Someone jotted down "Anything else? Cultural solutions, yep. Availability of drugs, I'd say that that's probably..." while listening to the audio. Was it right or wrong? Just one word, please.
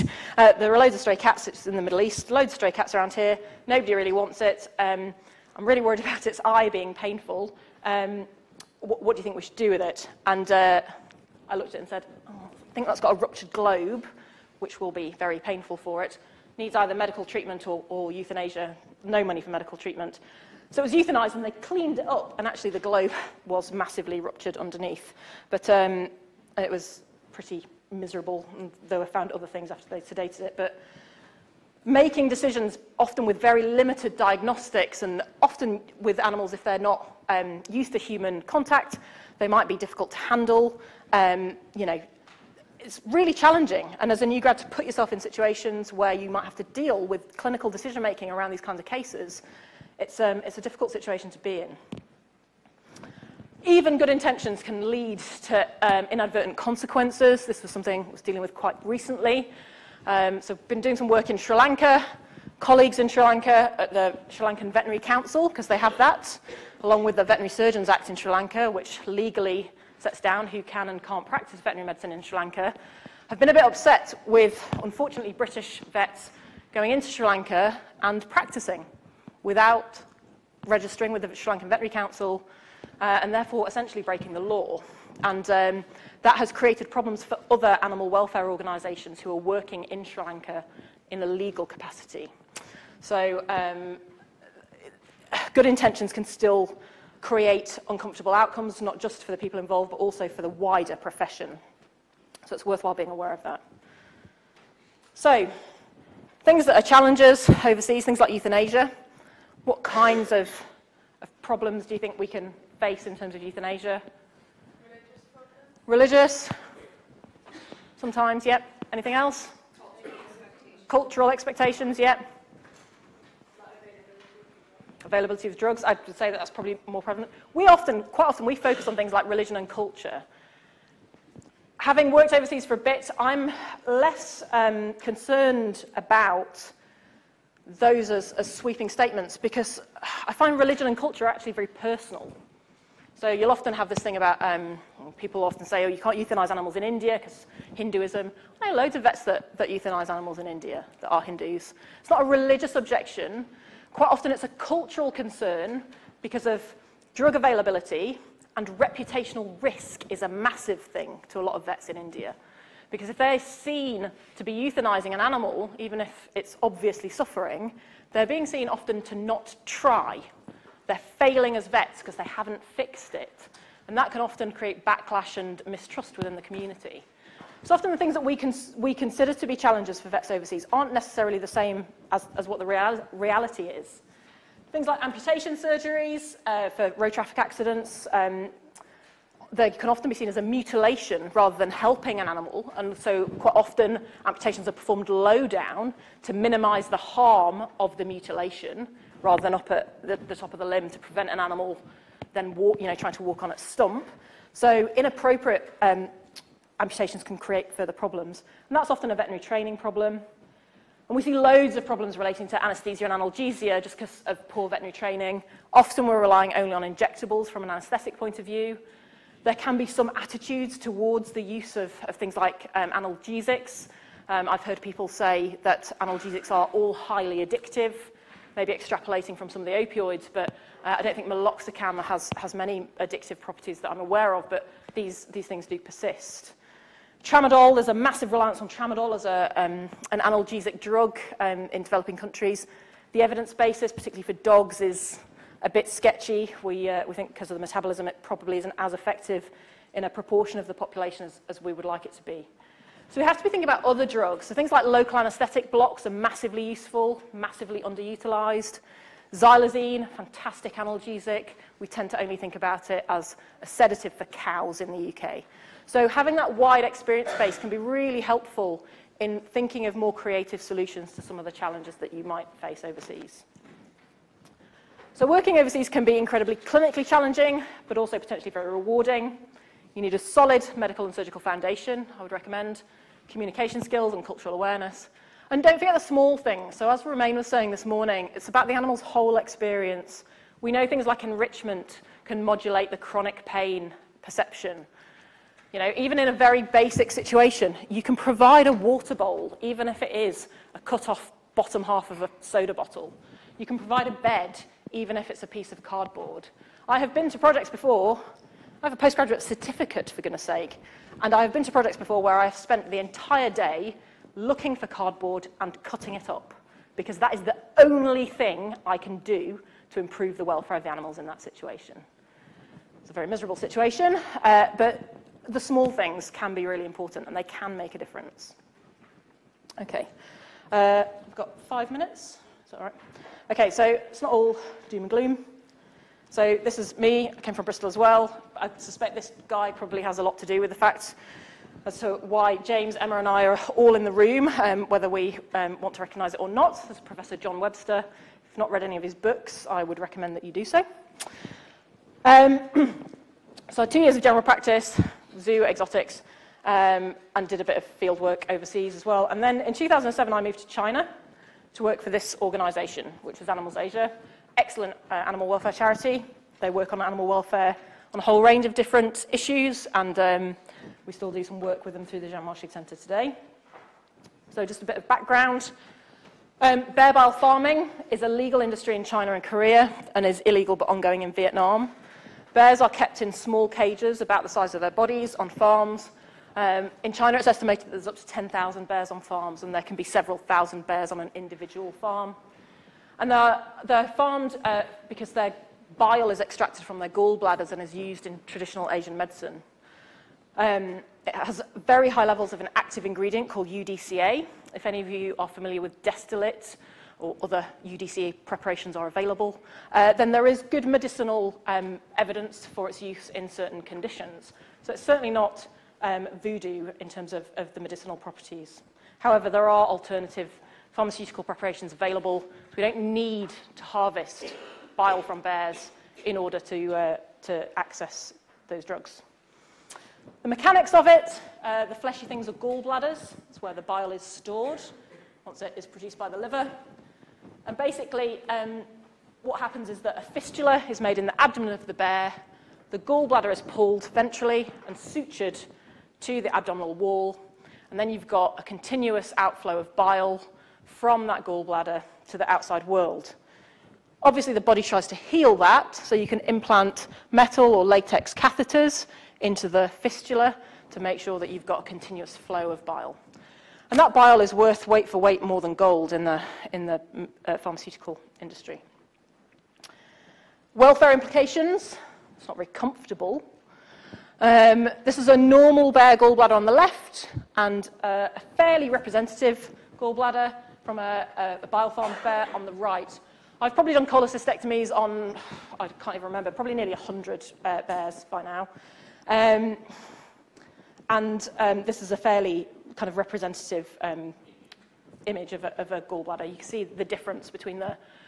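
wrong.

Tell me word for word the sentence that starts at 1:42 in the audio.
So it's worthwhile being aware of that.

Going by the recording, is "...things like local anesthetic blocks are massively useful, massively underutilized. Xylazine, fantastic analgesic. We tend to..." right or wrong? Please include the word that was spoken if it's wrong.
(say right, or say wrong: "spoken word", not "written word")
right.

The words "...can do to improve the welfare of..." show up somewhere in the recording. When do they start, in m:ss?
5:18.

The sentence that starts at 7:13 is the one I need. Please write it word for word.
It's where the bile is stored once it is produced by the liver.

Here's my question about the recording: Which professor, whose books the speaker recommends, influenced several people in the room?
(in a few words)
John Webster.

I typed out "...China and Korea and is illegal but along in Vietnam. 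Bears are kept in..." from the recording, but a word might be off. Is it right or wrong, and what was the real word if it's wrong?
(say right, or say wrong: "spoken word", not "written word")
wrong: "ongoing", not "along".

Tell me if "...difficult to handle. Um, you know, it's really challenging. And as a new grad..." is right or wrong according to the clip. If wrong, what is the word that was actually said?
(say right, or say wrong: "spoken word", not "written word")
right.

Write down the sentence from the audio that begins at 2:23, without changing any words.
So you'll often have this thing about um, people often say, oh, you can't euthanize animals in India because Hinduism.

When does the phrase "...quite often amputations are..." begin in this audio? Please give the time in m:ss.
3:13.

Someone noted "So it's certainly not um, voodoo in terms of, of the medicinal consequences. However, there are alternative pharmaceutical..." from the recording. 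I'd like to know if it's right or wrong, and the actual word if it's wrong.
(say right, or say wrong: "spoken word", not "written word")
wrong: "properties", not "consequences".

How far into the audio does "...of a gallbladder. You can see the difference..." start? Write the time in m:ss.
8:15.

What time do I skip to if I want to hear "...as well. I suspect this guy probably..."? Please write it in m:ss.
5:37.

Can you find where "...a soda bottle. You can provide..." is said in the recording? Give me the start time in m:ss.
5:02.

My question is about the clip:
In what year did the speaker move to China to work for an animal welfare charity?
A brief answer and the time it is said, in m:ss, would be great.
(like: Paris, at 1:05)
2007, at 5:59.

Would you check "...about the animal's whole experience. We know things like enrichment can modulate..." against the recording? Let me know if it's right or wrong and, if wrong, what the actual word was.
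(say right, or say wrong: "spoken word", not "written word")
right.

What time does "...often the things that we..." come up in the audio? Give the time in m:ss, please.
2:57.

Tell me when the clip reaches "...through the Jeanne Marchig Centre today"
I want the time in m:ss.
6:12.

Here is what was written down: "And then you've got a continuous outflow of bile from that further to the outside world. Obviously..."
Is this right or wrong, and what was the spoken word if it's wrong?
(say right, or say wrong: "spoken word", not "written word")
wrong: "gallbladder", not "further".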